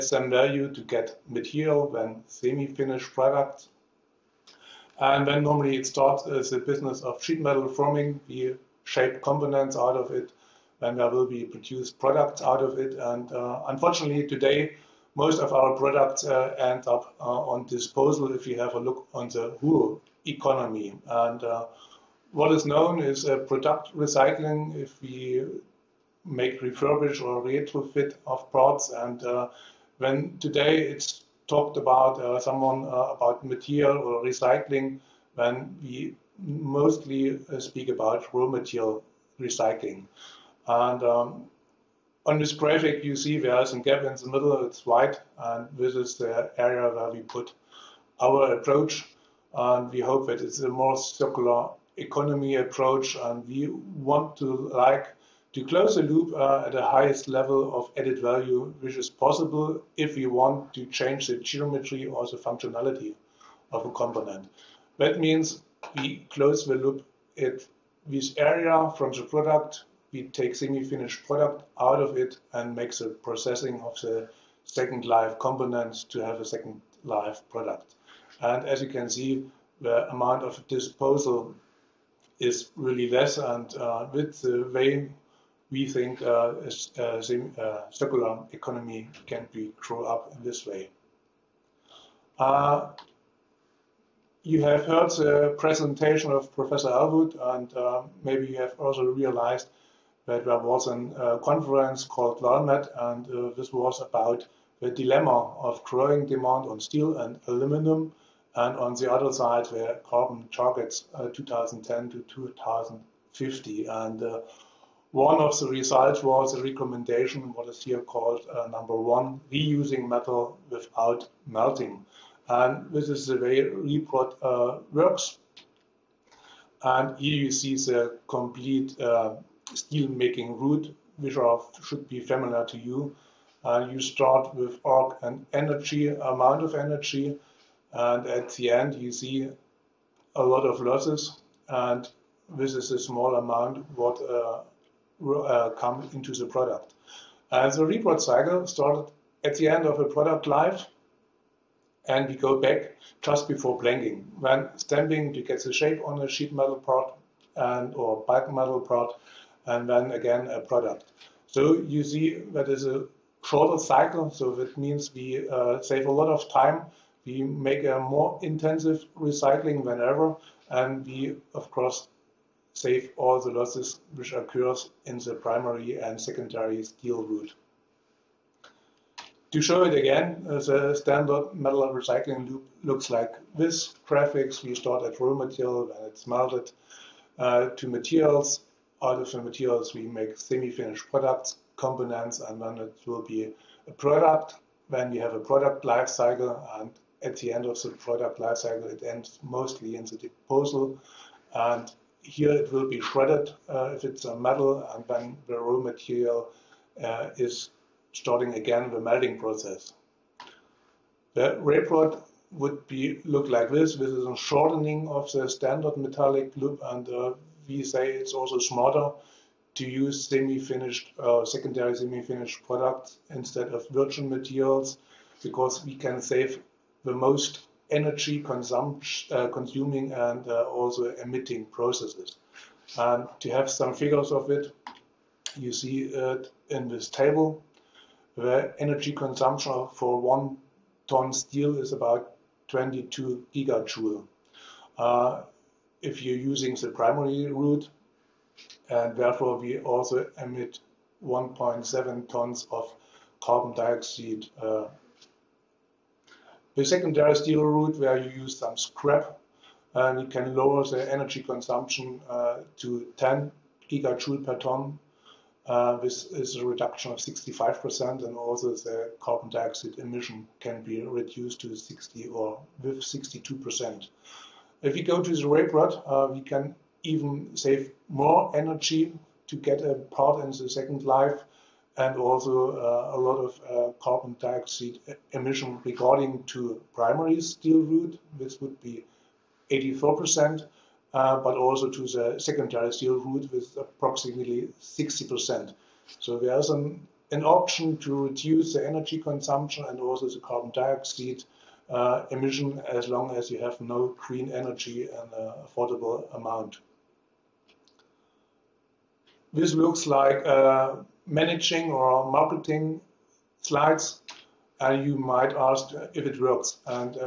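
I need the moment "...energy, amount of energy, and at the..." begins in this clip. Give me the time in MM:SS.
02:15.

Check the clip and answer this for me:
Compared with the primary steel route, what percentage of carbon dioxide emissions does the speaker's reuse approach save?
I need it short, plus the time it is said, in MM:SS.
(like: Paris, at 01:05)
84%, at 04:49.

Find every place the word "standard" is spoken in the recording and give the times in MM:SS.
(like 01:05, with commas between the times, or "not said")
03:00, 03:35.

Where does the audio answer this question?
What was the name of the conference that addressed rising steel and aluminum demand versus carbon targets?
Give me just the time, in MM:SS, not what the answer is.
01:42.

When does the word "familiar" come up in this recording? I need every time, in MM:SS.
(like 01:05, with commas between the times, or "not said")
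02:12.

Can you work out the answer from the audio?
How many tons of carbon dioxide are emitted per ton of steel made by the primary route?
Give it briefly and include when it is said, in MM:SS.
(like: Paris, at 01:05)
1.7 tons, at 04:11.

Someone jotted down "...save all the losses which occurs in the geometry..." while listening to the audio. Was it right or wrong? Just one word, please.
wrong.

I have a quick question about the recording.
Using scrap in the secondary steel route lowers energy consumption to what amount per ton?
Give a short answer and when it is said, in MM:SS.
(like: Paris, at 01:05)
10 gigajoules, at 04:23.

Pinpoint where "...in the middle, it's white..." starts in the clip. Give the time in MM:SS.
00:44.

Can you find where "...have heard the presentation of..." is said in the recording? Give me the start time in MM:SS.
01:34.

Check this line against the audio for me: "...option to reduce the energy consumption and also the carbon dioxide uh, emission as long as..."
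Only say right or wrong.
right.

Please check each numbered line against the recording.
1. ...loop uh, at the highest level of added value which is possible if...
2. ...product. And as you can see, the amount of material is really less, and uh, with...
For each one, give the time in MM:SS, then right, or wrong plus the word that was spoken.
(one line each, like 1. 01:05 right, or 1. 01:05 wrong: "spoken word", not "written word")
1. 00:56 right
2. 01:17 wrong: "disposal", not "material".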